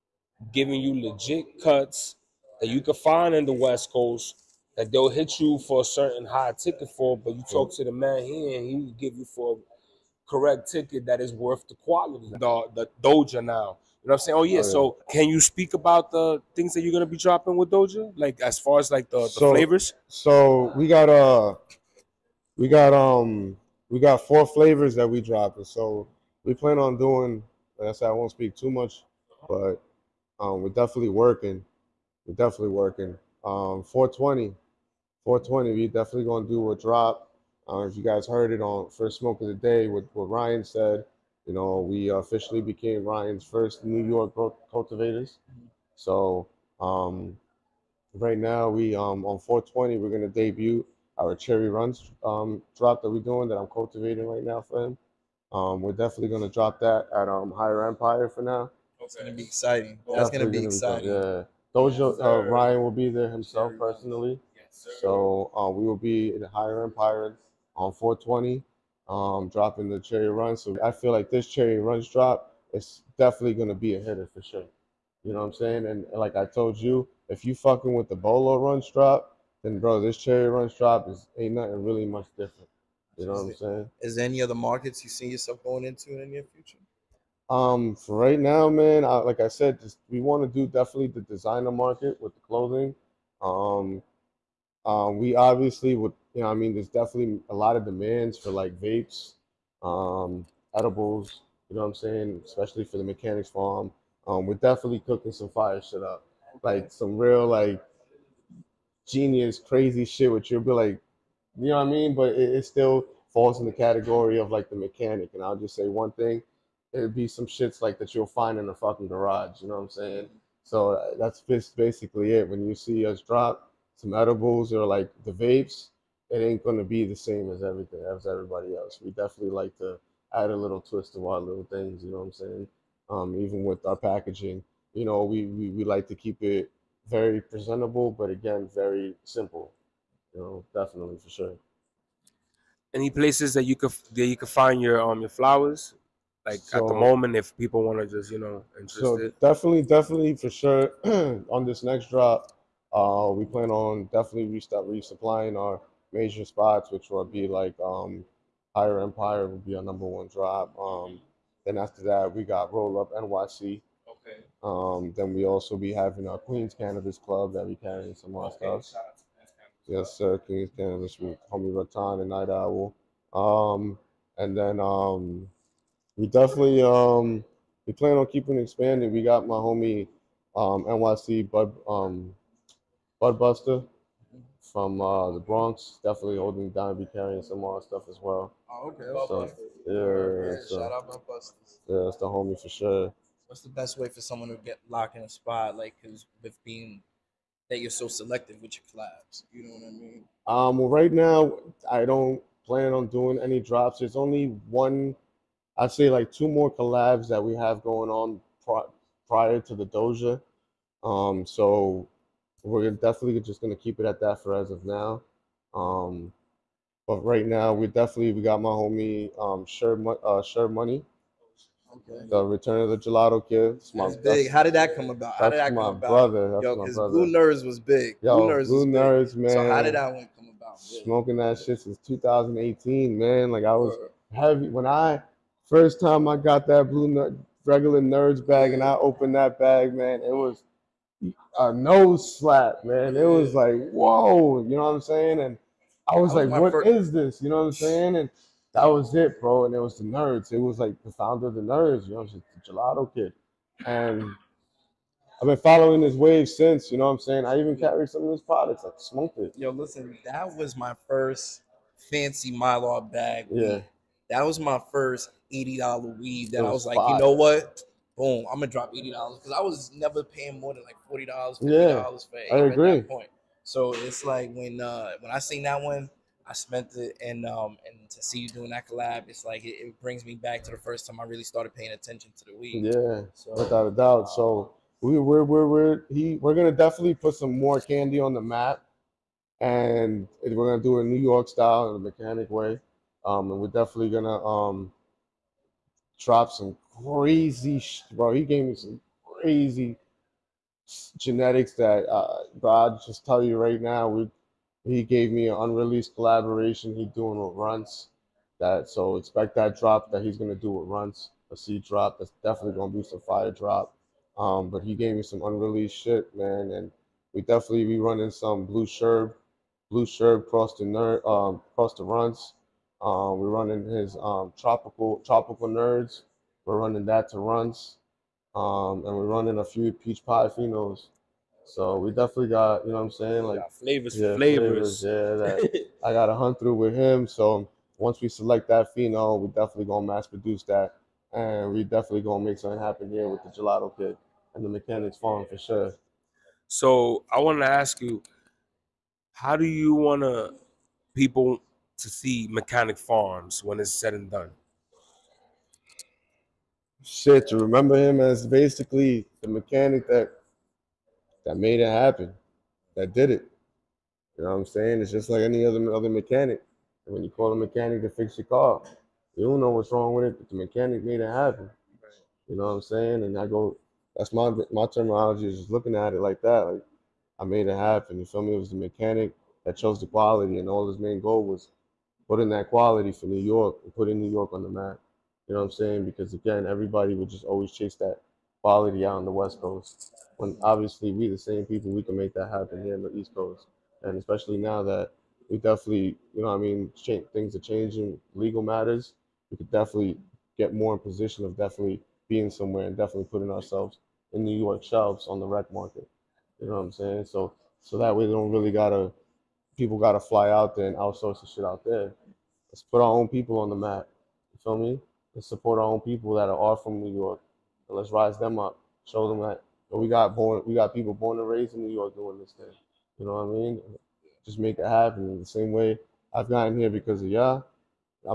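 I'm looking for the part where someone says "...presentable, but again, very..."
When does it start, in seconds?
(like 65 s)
137 s.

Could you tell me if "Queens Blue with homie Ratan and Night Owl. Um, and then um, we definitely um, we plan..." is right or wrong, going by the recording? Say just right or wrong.
wrong.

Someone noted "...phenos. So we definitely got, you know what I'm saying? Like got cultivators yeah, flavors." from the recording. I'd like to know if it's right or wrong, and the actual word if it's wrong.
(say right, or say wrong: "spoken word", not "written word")
wrong: "flavors", not "cultivators".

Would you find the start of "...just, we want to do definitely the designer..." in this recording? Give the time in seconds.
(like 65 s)
89 s.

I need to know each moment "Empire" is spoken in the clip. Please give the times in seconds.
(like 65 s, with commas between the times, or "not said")
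57 s, 66 s, 159 s.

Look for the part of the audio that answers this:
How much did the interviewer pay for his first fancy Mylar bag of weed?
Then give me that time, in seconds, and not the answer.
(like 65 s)
265 s.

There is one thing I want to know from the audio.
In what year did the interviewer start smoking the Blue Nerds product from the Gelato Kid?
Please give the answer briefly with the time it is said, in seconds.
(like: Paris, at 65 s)
2018, at 232 s.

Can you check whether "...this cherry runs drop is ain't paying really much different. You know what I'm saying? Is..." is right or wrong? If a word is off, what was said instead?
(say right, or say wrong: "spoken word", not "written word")
wrong: "nothing", not "paying".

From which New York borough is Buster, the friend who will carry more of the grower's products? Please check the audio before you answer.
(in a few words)
The Bronx.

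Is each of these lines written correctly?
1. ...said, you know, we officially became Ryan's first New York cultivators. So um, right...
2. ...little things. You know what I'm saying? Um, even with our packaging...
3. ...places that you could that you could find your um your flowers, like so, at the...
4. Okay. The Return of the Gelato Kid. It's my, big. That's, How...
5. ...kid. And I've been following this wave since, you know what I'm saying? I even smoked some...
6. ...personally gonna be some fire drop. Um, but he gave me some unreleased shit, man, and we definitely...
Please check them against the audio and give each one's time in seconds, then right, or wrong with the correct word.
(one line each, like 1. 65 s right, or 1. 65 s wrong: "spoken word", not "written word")
1. 40 s right
2. 131 s right
3. 143 s right
4. 221 s right
5. 253 s wrong: "carried", not "smoked"
6. 312 s wrong: "definitely", not "personally".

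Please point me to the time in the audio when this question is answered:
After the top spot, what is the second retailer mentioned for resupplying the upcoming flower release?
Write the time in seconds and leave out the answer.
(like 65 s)
162 s.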